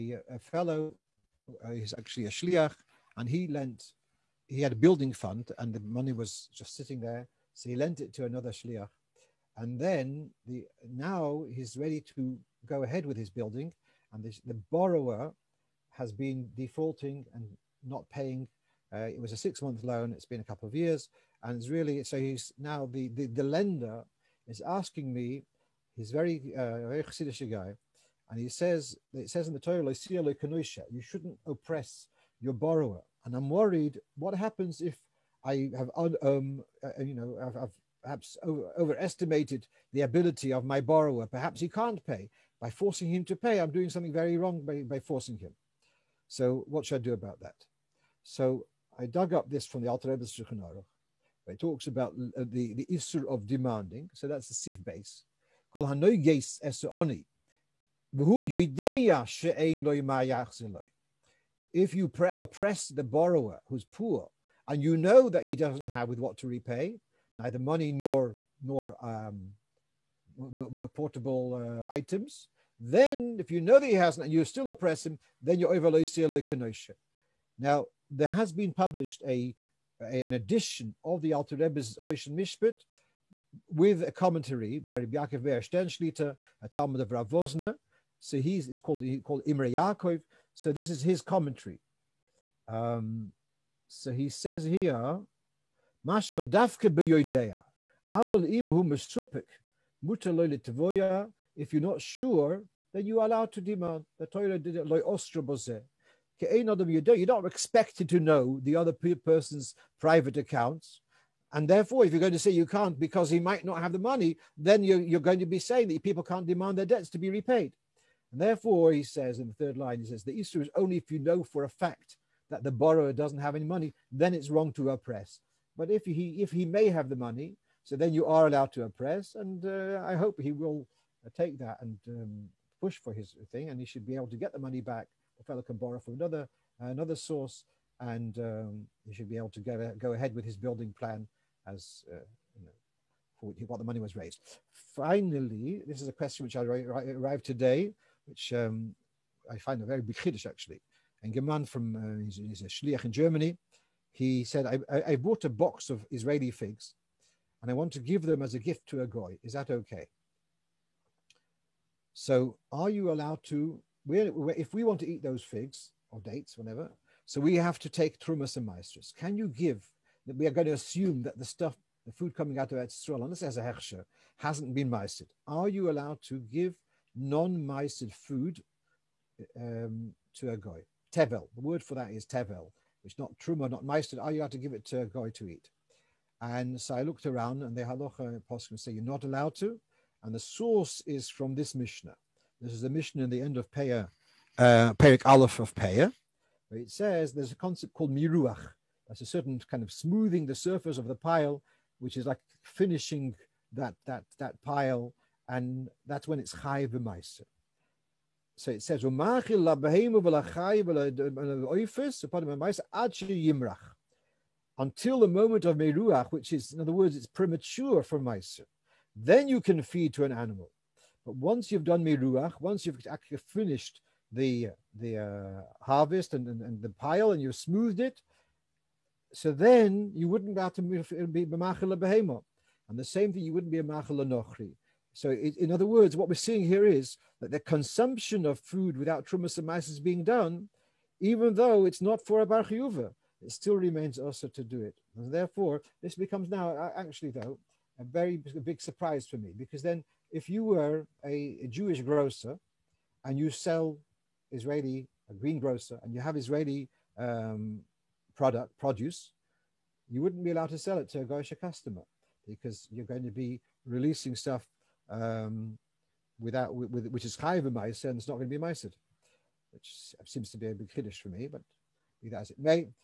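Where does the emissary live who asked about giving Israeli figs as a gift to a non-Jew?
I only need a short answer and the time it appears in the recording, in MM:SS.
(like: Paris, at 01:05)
Germany, at 02:33.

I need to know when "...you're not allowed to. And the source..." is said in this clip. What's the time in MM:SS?
03:08.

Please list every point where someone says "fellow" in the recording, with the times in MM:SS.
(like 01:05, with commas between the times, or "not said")
00:00, 02:15.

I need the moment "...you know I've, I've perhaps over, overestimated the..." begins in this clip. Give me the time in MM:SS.
00:37.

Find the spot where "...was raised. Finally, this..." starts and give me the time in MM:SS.
02:23.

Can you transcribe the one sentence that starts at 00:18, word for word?
Uh, it was a six-month loan.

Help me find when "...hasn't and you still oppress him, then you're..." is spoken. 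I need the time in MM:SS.
01:13.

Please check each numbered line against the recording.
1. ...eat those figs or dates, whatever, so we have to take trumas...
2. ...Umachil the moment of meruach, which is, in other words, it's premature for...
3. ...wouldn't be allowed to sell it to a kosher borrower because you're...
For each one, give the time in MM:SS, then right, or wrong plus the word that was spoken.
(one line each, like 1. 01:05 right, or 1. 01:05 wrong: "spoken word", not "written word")
1. 02:45 right
2. 03:34 wrong: "until", not "Umachil"
3. 04:20 wrong: "customer", not "borrower".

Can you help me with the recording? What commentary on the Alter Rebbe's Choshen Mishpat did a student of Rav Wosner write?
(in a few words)
Imre Yaakov.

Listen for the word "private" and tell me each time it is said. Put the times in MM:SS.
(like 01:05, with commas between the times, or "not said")
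01:49.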